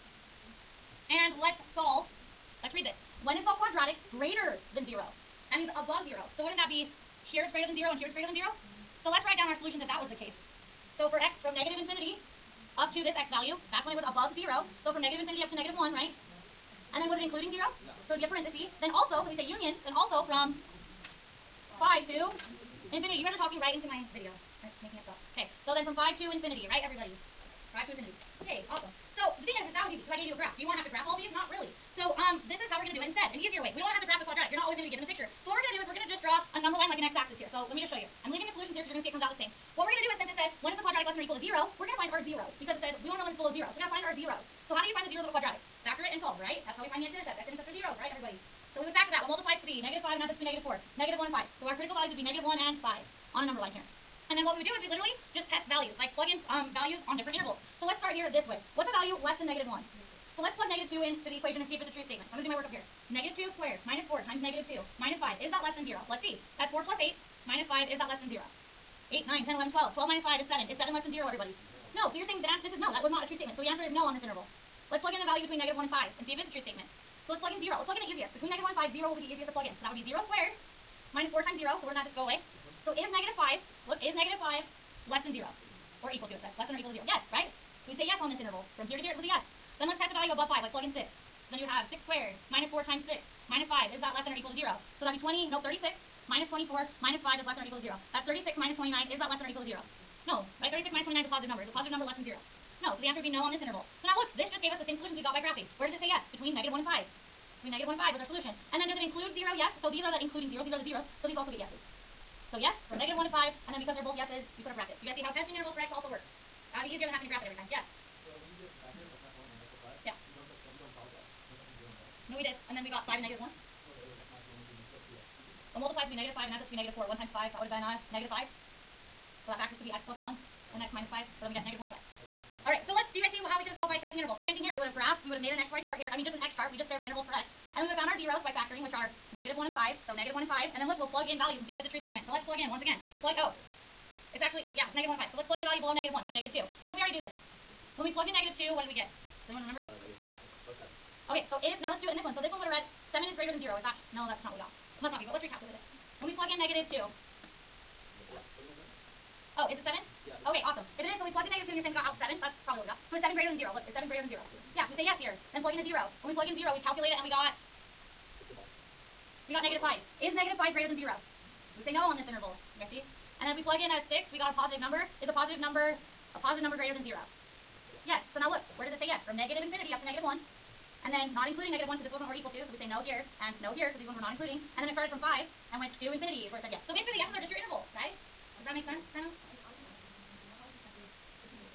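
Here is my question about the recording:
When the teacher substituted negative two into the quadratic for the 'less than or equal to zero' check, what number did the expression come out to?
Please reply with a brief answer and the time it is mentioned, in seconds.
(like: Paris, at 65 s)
7, at 69 s.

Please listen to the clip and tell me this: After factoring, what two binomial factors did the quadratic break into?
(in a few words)
x + 1 and x - 5.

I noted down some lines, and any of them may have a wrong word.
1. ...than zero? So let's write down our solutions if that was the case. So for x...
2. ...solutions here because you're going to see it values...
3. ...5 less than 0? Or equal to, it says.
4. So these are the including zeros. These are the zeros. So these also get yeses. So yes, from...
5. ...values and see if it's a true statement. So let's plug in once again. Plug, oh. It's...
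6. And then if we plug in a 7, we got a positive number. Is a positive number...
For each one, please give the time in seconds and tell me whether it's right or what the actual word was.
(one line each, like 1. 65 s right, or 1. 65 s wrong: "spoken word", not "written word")
1. 8 s right
2. 38 s wrong: "comes", not "values"
3. 84 s right
4. 109 s right
5. 141 s right
6. 173 s wrong: "6", not "7".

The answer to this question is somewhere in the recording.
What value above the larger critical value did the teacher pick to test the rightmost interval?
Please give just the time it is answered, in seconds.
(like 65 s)
90 s.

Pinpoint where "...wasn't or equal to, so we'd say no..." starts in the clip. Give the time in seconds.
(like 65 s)
182 s.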